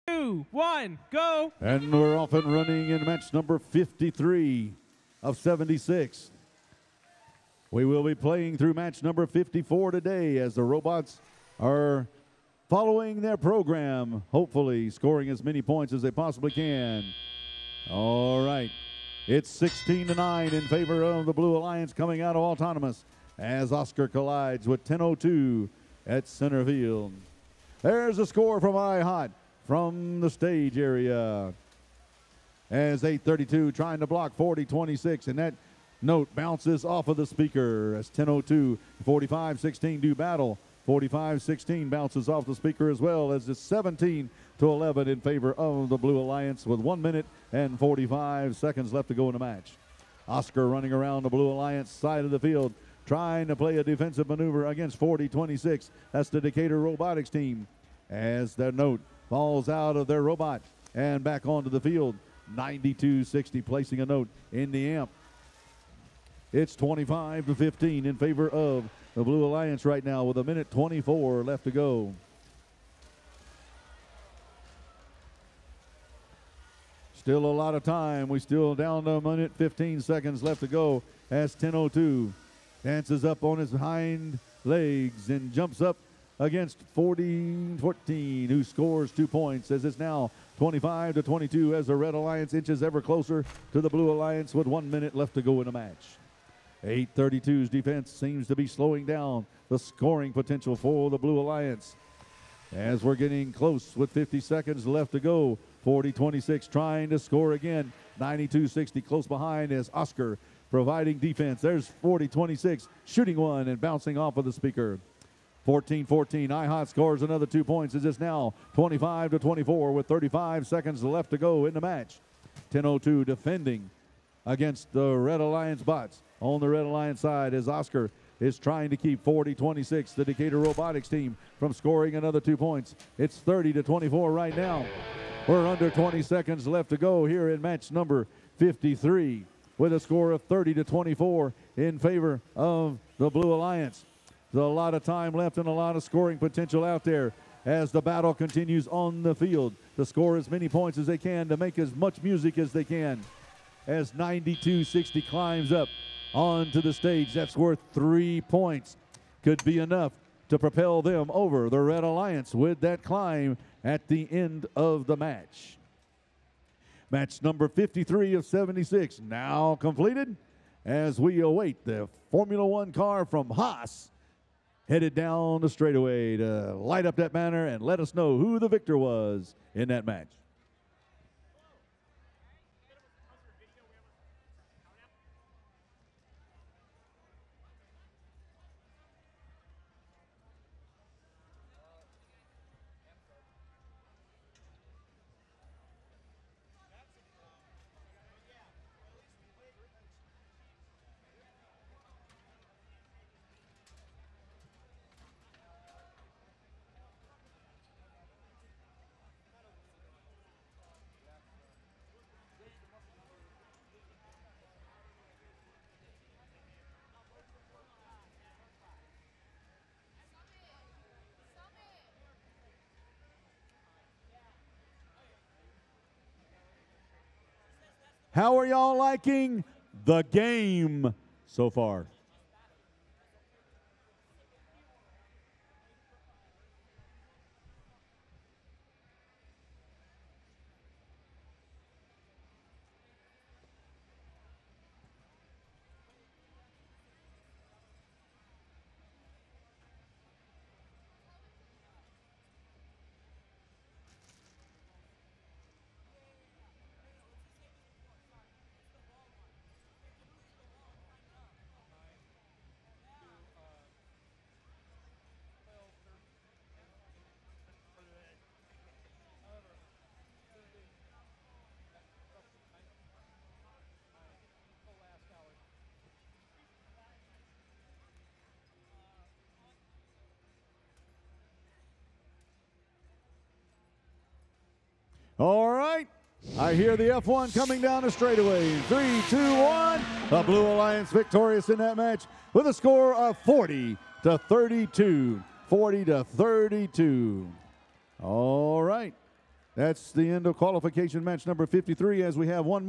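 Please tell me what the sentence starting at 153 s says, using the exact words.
As 92-60 climbs up onto the stage, that's worth three points.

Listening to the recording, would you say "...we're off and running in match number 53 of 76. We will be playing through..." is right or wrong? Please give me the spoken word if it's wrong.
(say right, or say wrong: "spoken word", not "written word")
right.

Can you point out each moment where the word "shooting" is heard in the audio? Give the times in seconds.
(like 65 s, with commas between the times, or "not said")
113 s.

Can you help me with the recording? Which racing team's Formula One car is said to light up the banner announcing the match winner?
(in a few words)
Haas.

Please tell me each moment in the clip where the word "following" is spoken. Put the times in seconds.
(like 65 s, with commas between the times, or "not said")
12 s.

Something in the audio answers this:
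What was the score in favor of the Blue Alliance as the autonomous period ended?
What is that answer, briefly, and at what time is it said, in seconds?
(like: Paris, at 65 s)
16 to 9, at 19 s.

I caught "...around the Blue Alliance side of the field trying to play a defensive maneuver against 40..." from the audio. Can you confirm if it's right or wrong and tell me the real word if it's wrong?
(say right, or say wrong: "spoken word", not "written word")
right.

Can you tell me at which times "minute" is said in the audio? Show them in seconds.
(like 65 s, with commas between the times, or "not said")
47 s, 70 s, 79 s, 94 s.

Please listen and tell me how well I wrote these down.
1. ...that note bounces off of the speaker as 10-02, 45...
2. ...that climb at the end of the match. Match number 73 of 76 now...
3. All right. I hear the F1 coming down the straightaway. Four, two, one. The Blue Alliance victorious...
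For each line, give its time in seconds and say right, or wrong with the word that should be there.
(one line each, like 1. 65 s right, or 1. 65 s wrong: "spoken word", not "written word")
1. 35 s right
2. 162 s wrong: "53", not "73"
3. 285 s wrong: "Three", not "Four".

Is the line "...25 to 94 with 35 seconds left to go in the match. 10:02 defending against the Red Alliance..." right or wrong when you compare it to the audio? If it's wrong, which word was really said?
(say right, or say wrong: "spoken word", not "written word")
wrong: "24", not "94".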